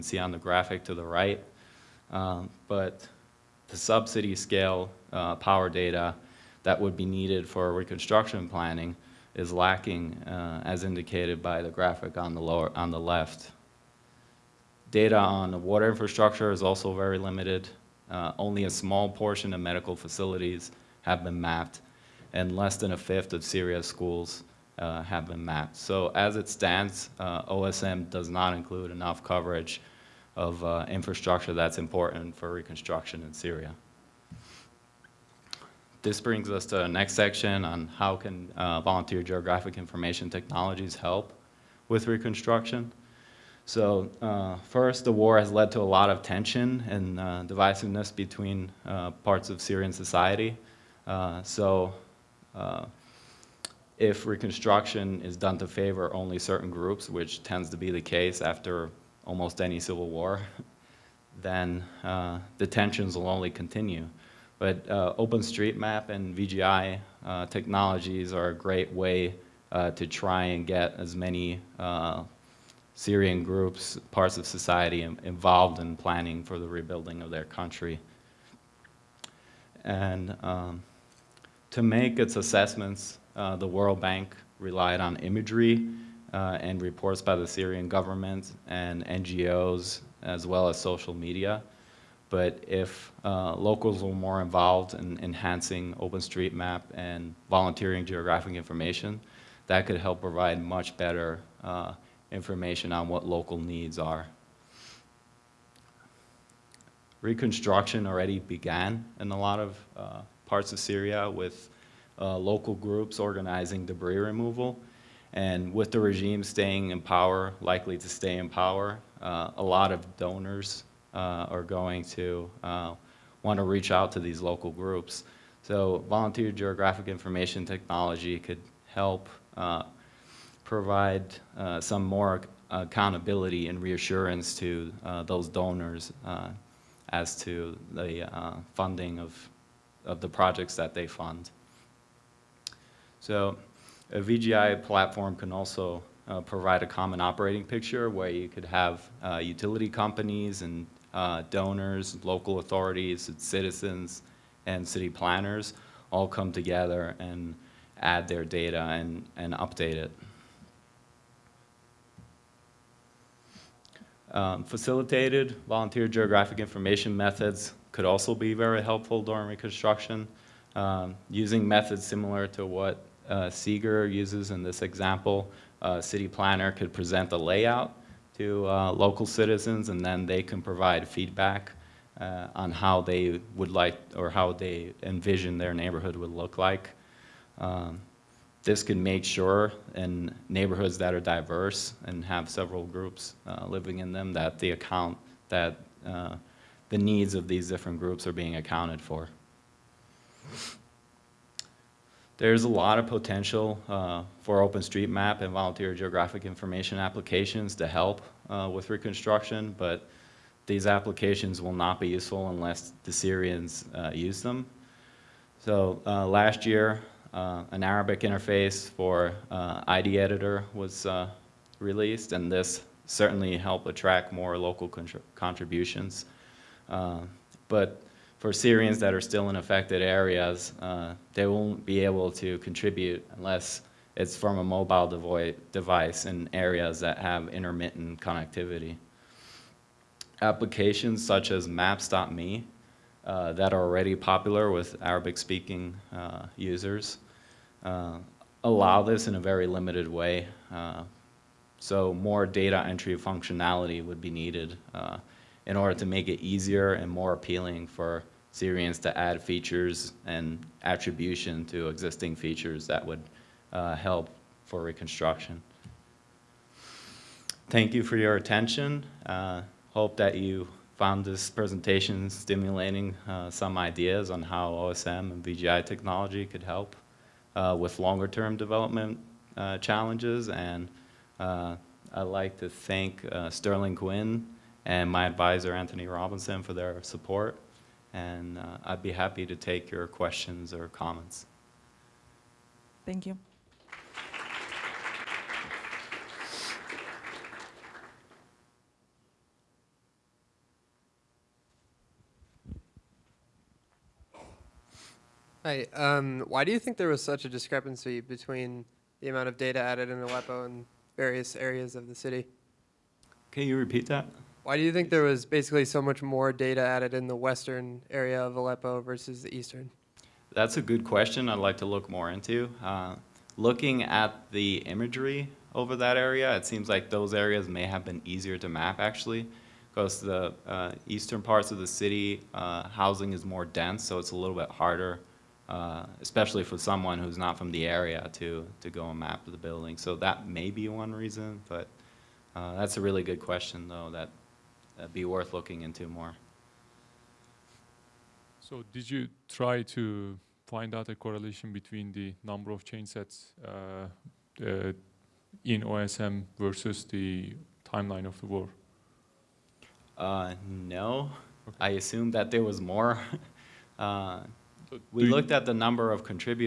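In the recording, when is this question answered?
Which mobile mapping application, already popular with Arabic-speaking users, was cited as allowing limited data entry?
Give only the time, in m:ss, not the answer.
4:01.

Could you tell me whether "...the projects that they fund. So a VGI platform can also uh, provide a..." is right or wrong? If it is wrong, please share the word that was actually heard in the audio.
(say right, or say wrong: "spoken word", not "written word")
right.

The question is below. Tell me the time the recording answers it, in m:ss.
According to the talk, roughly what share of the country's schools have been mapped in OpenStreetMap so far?
0:22.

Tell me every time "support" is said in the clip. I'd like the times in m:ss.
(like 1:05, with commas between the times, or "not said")
4:47.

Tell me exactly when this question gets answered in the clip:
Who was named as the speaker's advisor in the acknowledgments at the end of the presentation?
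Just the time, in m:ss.
4:45.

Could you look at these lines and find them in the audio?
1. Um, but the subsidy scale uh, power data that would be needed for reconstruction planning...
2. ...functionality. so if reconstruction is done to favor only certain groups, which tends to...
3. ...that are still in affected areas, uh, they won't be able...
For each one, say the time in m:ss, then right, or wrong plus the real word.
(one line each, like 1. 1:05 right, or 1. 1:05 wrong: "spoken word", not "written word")
1. 0:02 right
2. 0:49 wrong: "society", not "functionality"
3. 3:48 right.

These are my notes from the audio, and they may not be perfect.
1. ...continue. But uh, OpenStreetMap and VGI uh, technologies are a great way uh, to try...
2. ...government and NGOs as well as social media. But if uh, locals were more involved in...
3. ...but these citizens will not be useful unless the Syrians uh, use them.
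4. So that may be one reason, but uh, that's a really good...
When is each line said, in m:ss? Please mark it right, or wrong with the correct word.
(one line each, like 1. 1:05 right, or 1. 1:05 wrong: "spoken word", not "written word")
1. 1:03 right
2. 1:27 right
3. 3:29 wrong: "applications", not "citizens"
4. 5:39 right.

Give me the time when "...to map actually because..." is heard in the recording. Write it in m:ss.
5:28.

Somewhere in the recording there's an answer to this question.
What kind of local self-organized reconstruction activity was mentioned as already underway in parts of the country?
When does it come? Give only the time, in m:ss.
1:53.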